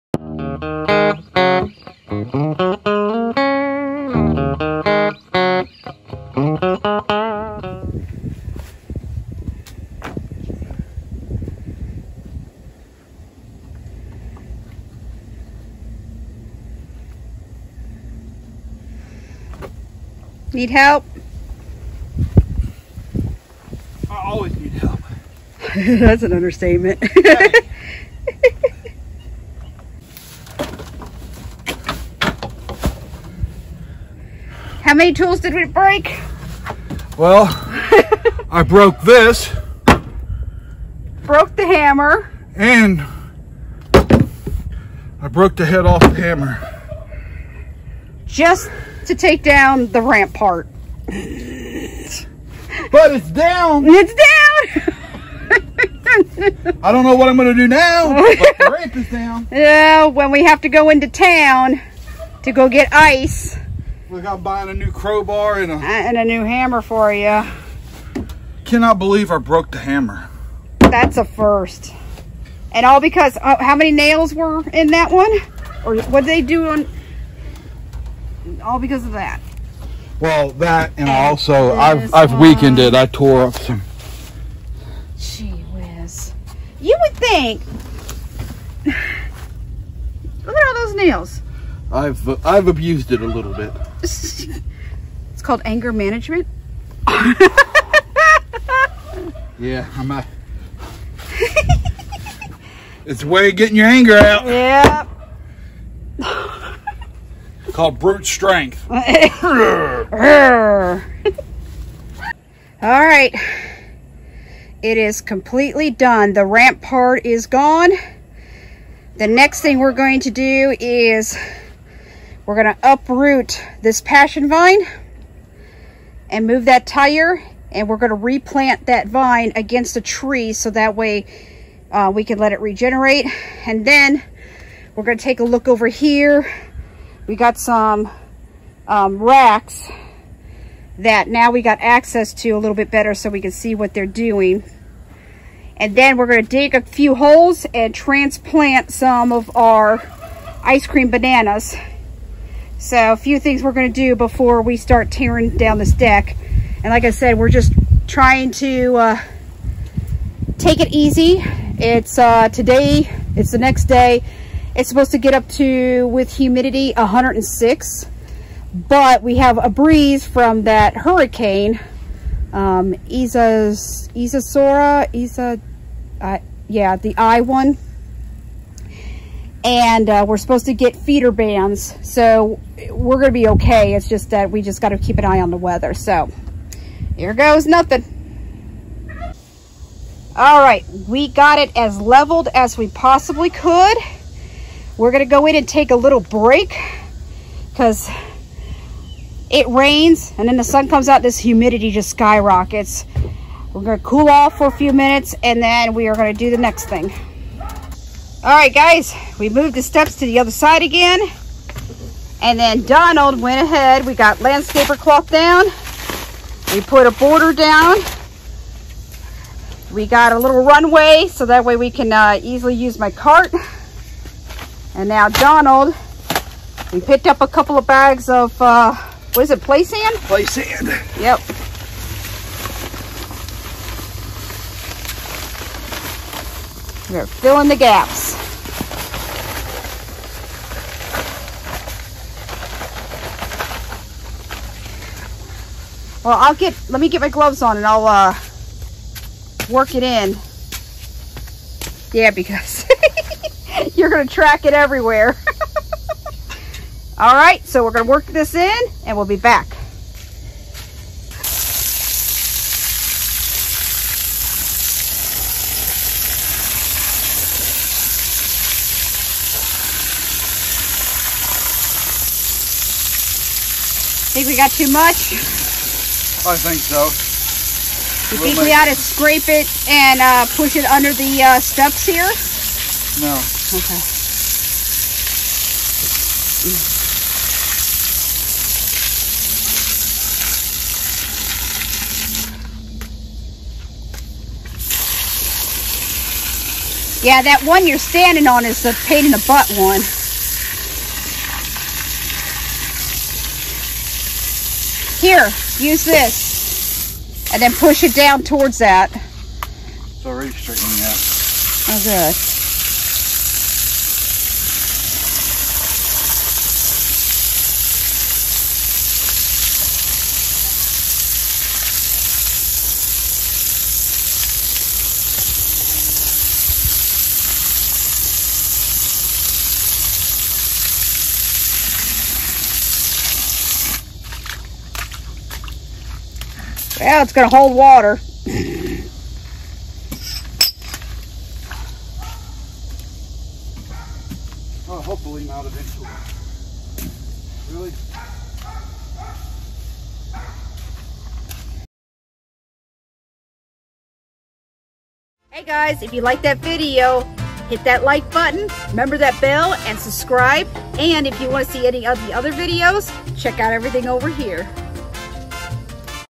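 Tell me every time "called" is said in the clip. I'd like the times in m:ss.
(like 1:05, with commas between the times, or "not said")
1:35, 1:47.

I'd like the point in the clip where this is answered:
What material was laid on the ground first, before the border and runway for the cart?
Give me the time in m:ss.
3:34.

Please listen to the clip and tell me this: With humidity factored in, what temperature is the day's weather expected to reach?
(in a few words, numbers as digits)
106.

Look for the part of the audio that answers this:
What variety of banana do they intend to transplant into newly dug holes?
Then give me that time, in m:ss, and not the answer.
2:30.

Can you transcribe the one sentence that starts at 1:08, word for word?
Cannot believe I broke the hammer.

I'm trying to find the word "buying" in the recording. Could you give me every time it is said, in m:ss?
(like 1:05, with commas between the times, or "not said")
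1:04.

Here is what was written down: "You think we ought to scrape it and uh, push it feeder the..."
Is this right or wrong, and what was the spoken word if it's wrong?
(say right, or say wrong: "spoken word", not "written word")
wrong: "under", not "feeder".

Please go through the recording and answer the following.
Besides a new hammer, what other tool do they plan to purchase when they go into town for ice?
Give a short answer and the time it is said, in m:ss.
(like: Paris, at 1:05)
crowbar, at 1:04.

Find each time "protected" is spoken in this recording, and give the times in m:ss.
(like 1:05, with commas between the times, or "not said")
not said.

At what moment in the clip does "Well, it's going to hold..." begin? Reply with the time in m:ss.
5:37.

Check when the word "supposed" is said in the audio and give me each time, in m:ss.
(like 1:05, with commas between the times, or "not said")
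2:44, 3:00.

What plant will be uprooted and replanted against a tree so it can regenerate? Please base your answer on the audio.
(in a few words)
passion vine.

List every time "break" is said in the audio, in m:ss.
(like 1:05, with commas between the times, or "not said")
0:35, 3:16.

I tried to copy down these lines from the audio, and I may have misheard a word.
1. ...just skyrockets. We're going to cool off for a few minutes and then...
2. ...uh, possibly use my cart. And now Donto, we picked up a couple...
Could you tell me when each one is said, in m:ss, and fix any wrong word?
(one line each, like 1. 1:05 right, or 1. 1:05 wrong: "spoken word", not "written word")
1. 3:21 right
2. 3:42 wrong: "easily", not "possibly".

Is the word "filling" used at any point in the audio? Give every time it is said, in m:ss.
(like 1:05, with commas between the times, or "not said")
3:57.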